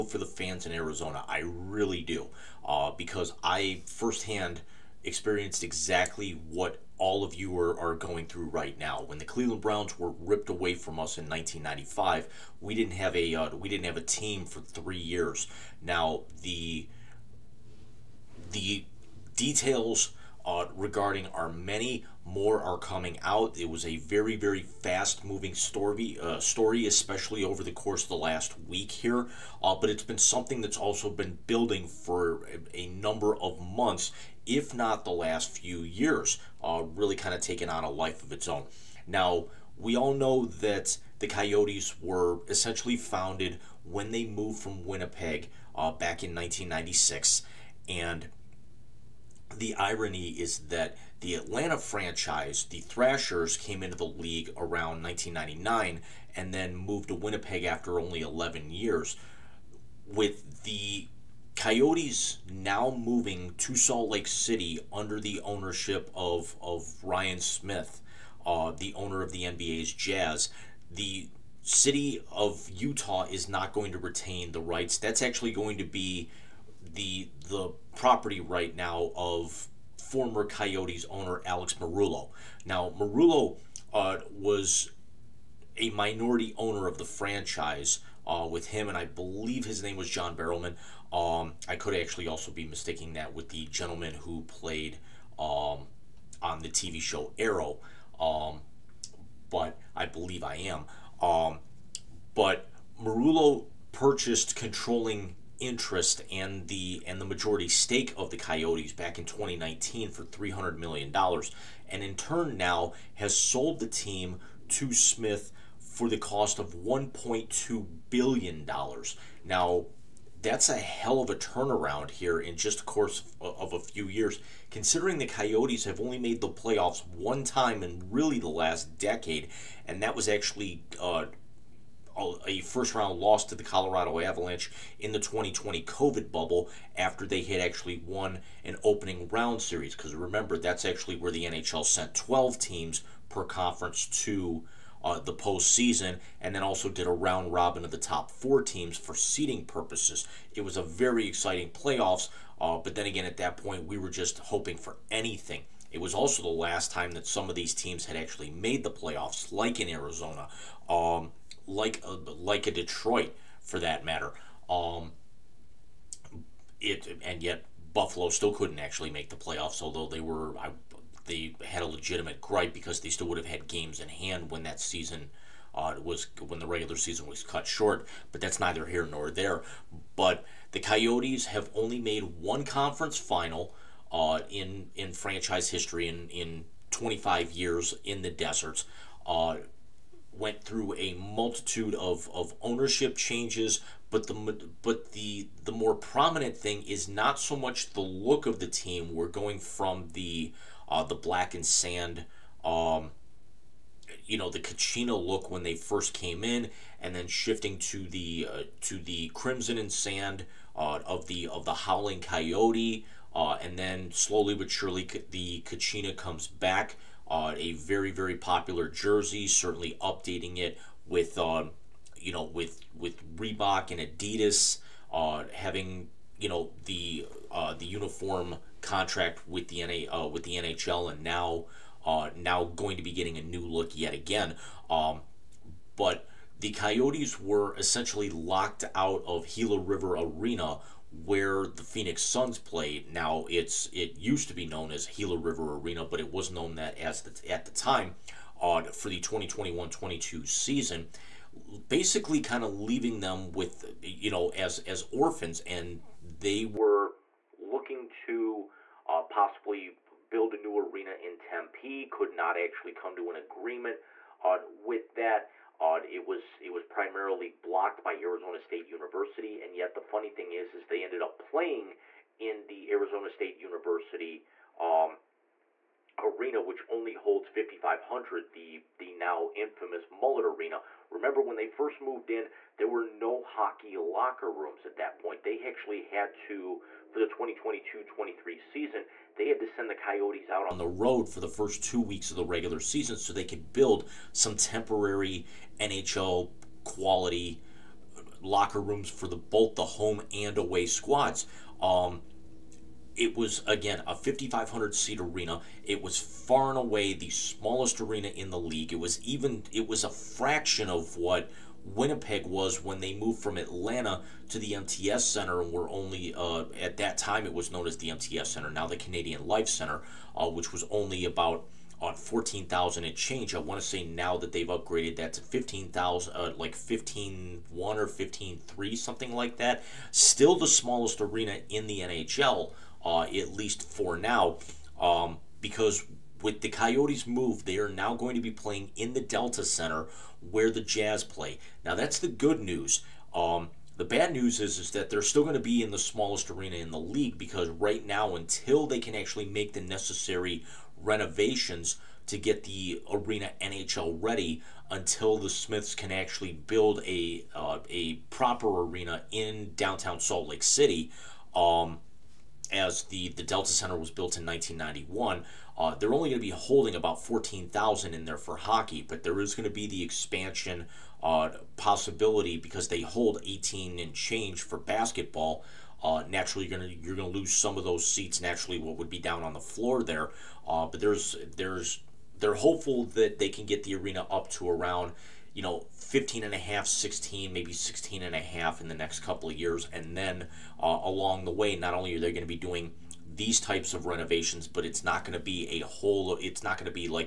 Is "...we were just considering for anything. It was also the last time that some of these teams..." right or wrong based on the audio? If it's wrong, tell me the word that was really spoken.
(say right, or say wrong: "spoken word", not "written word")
wrong: "hoping", not "considering".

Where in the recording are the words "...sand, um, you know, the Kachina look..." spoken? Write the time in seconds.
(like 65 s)
201 s.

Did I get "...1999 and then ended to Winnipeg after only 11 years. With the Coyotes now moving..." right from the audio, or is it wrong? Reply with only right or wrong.
wrong.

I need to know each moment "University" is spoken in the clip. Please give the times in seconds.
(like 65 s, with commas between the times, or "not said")
268 s, 273 s.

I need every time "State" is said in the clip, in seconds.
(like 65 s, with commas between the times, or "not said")
268 s, 273 s.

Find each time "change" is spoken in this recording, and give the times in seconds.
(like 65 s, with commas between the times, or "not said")
193 s, 323 s, 374 s.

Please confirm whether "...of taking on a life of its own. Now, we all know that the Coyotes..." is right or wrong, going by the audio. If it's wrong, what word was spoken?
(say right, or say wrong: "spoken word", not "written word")
right.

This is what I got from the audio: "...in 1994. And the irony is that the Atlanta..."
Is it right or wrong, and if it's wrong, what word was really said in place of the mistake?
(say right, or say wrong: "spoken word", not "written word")
wrong: "1996", not "1994".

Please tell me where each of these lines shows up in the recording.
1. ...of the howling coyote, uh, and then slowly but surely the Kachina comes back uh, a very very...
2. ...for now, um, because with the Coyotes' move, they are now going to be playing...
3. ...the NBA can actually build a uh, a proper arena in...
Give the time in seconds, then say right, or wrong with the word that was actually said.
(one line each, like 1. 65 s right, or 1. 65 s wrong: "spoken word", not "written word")
1. 211 s right
2. 333 s right
3. 355 s wrong: "Smiths", not "NBA".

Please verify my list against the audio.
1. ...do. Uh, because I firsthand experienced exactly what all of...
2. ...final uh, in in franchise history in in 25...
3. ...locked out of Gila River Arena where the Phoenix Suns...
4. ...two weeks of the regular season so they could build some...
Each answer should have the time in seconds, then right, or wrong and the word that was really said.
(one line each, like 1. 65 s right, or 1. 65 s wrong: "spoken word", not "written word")
1. 2 s right
2. 183 s right
3. 238 s right
4. 291 s right.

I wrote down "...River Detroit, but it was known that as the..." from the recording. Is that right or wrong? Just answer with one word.
wrong.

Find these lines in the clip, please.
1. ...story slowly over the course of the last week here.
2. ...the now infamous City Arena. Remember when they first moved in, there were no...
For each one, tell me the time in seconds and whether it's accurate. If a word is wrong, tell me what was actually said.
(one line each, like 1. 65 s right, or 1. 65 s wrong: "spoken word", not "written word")
1. 26 s wrong: "especially", not "slowly"
2. 278 s wrong: "Mullet", not "City".